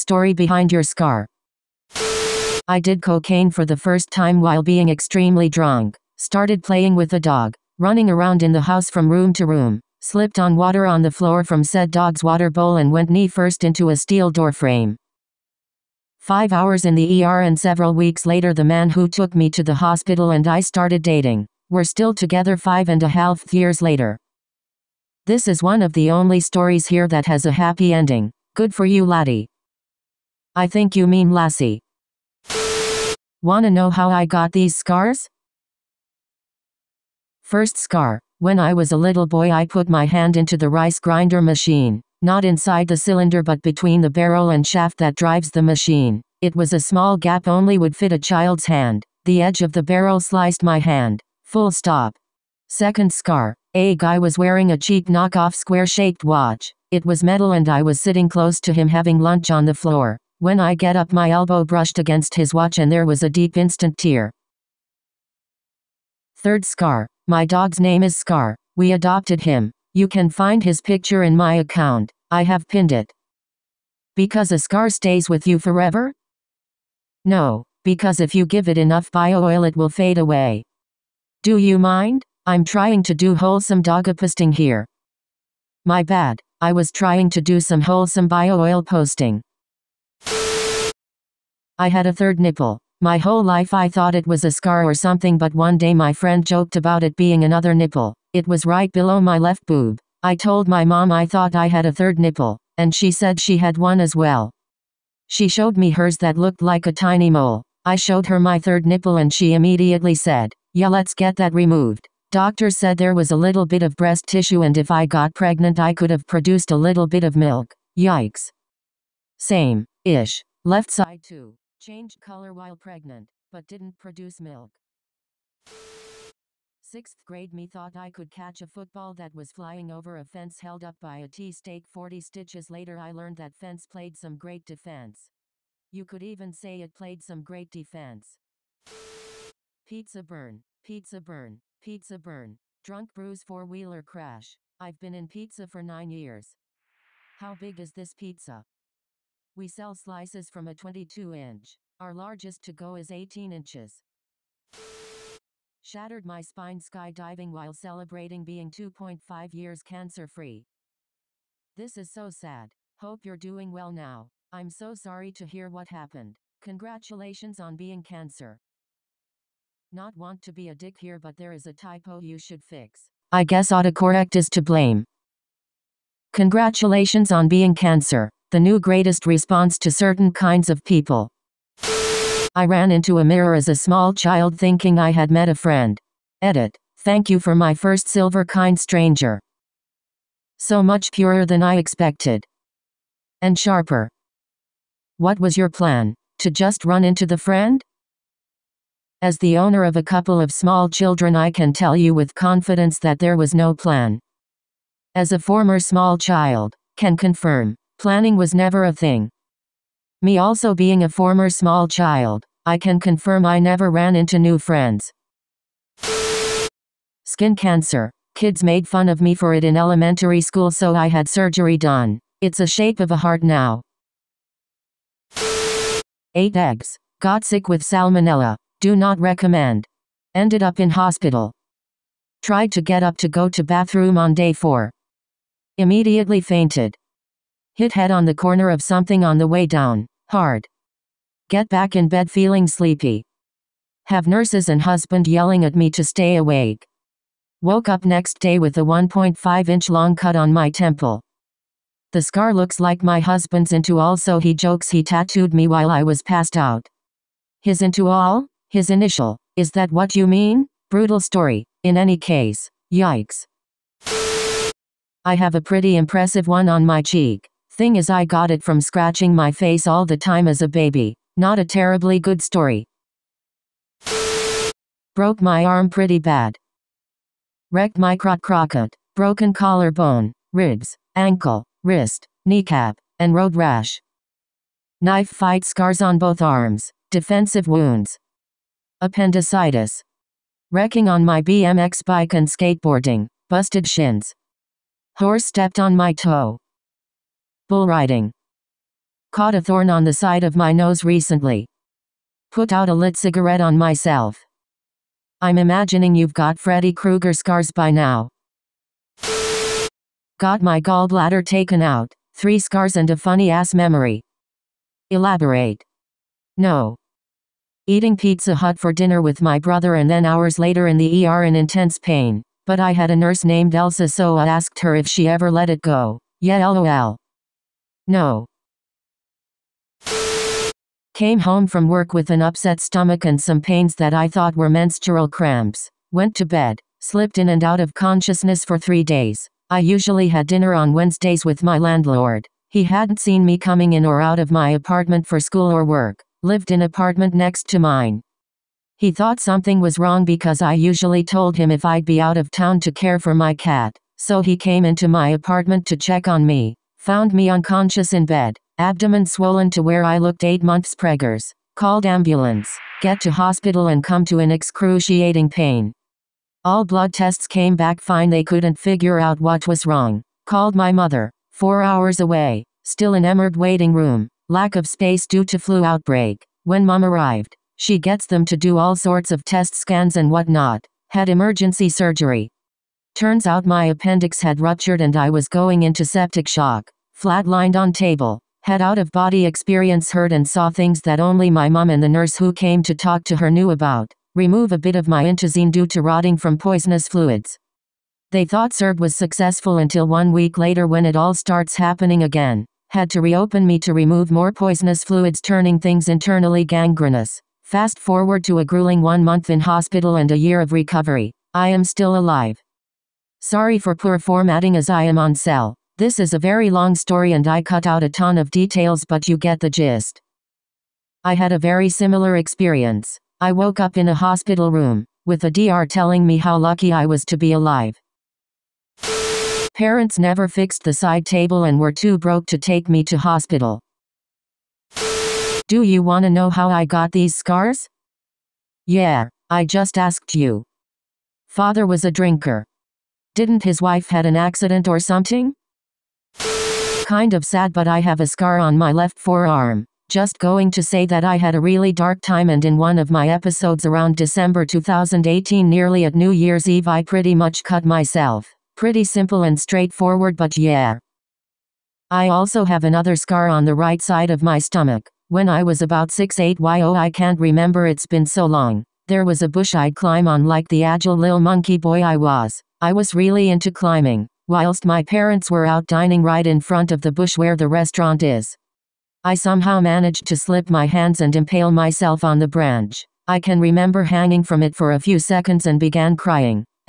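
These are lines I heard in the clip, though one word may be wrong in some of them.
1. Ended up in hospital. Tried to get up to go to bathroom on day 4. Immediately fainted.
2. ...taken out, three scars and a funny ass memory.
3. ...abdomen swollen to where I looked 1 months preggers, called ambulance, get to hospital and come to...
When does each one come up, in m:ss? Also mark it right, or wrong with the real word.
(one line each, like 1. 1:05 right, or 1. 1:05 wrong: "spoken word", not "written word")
1. 3:50 right
2. 5:11 right
3. 5:58 wrong: "8", not "1".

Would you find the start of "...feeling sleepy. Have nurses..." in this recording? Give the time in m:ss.
4:02.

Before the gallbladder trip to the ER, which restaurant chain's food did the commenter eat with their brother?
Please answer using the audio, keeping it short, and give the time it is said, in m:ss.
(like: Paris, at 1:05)
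Pizza Hut, at 5:18.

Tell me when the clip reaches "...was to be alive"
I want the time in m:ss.
7:07.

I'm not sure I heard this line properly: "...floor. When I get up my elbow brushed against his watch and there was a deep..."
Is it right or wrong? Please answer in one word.
right.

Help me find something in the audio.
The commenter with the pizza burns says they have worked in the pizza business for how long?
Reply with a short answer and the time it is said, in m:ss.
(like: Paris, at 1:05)
9 years, at 2:25.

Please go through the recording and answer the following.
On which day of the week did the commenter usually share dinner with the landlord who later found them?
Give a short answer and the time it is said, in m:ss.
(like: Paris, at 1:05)
Wednesdays, at 5:40.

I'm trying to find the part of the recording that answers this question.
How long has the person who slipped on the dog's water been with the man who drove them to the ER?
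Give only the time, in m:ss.
0:22.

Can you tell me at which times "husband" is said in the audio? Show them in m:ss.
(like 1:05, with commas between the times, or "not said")
4:04, 4:13.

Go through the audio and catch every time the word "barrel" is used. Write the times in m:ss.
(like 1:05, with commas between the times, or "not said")
0:44, 0:49.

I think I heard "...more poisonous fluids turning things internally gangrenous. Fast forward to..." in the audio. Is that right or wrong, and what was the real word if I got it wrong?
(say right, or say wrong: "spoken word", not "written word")
right.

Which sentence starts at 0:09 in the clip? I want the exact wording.
Slipped on water on the floor from said dog's water bowl and went knee first into a steel door frame.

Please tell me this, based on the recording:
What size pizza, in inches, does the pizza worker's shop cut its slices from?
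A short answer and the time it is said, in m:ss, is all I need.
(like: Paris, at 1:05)
22 inch, at 2:30.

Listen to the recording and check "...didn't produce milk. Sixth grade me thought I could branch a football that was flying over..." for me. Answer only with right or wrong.
wrong.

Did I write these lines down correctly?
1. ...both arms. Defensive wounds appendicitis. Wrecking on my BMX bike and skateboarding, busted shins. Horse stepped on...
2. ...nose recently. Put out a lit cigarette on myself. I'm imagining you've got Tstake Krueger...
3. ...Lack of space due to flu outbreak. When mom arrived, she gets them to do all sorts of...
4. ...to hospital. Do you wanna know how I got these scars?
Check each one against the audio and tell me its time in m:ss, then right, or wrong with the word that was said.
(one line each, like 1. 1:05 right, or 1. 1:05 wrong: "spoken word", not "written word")
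1. 4:46 right
2. 5:00 wrong: "Freddy", not "Tstake"
3. 6:14 right
4. 7:13 right.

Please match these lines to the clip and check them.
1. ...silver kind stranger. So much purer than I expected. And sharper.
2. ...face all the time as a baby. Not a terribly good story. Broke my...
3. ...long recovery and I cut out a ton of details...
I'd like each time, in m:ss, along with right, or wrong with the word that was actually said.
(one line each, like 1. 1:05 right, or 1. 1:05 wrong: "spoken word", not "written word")
1. 3:08 right
2. 4:29 right
3. 6:56 wrong: "story", not "recovery".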